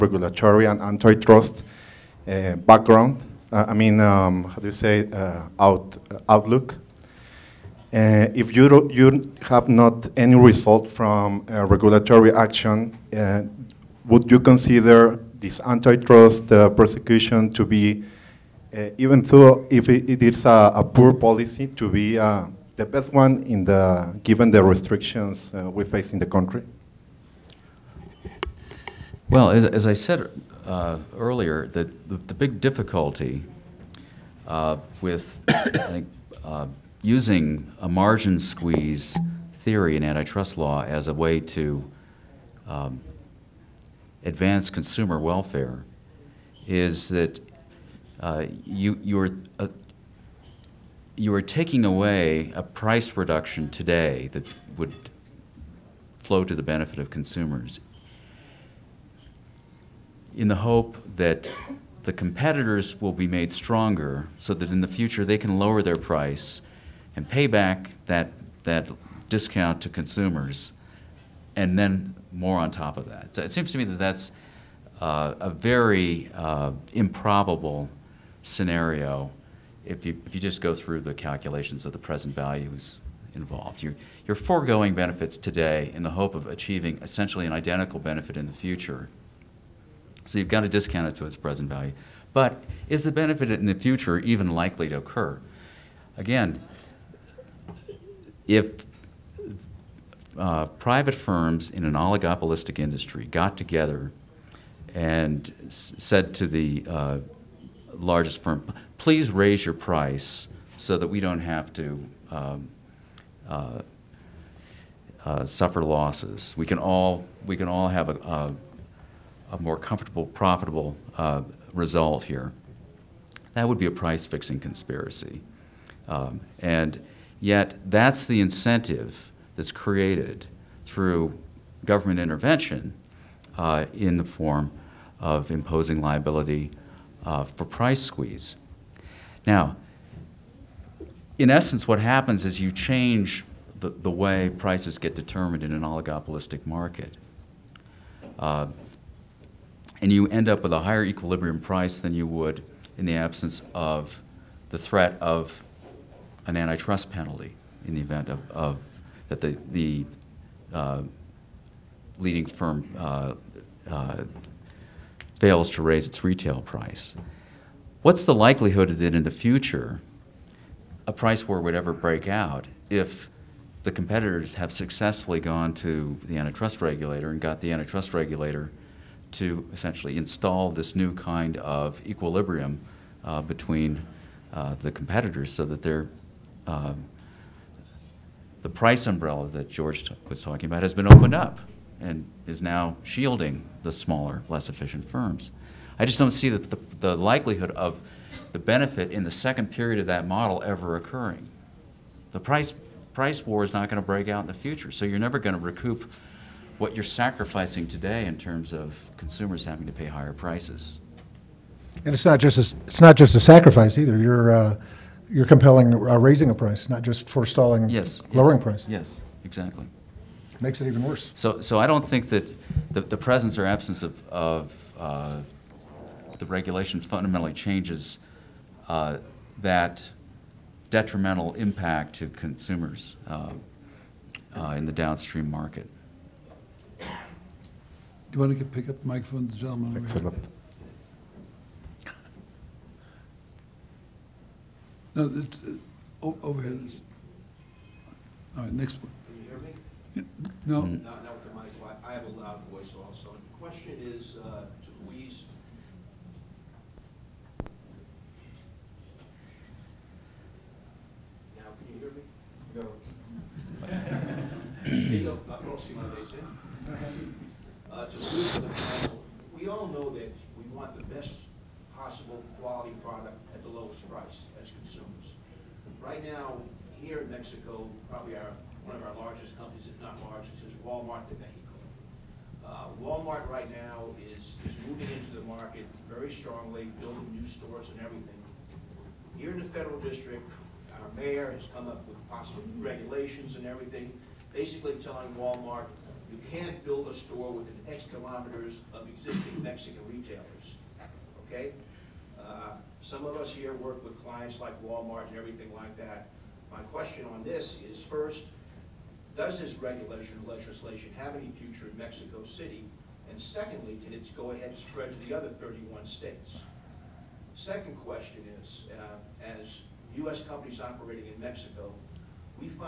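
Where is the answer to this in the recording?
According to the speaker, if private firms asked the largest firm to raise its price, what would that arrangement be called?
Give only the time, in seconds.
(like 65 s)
123 s.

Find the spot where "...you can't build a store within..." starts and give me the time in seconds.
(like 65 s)
296 s.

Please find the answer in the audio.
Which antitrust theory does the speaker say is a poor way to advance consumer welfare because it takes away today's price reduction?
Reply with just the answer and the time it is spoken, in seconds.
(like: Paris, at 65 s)
Margin squeeze, at 37 s.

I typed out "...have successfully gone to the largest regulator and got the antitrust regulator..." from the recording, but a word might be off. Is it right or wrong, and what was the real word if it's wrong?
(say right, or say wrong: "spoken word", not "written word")
wrong: "antitrust", not "largest".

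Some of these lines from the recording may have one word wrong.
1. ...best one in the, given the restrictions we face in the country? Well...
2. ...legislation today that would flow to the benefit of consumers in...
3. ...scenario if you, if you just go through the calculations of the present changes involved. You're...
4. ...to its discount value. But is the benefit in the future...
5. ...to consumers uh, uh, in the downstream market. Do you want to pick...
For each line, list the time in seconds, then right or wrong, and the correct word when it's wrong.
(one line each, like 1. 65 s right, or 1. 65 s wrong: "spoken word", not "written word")
1. 22 s right
2. 53 s wrong: "reduction", not "legislation"
3. 78 s wrong: "values", not "changes"
4. 91 s wrong: "present", not "discount"
5. 232 s right.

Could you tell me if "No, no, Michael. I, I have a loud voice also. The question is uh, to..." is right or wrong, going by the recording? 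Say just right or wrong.
right.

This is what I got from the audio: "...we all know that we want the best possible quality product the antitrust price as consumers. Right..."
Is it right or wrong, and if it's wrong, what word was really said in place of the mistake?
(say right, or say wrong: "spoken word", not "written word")
wrong: "lowest", not "antitrust".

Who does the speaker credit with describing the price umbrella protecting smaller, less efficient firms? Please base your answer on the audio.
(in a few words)
George.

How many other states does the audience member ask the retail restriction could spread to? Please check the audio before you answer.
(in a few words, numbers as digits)
31.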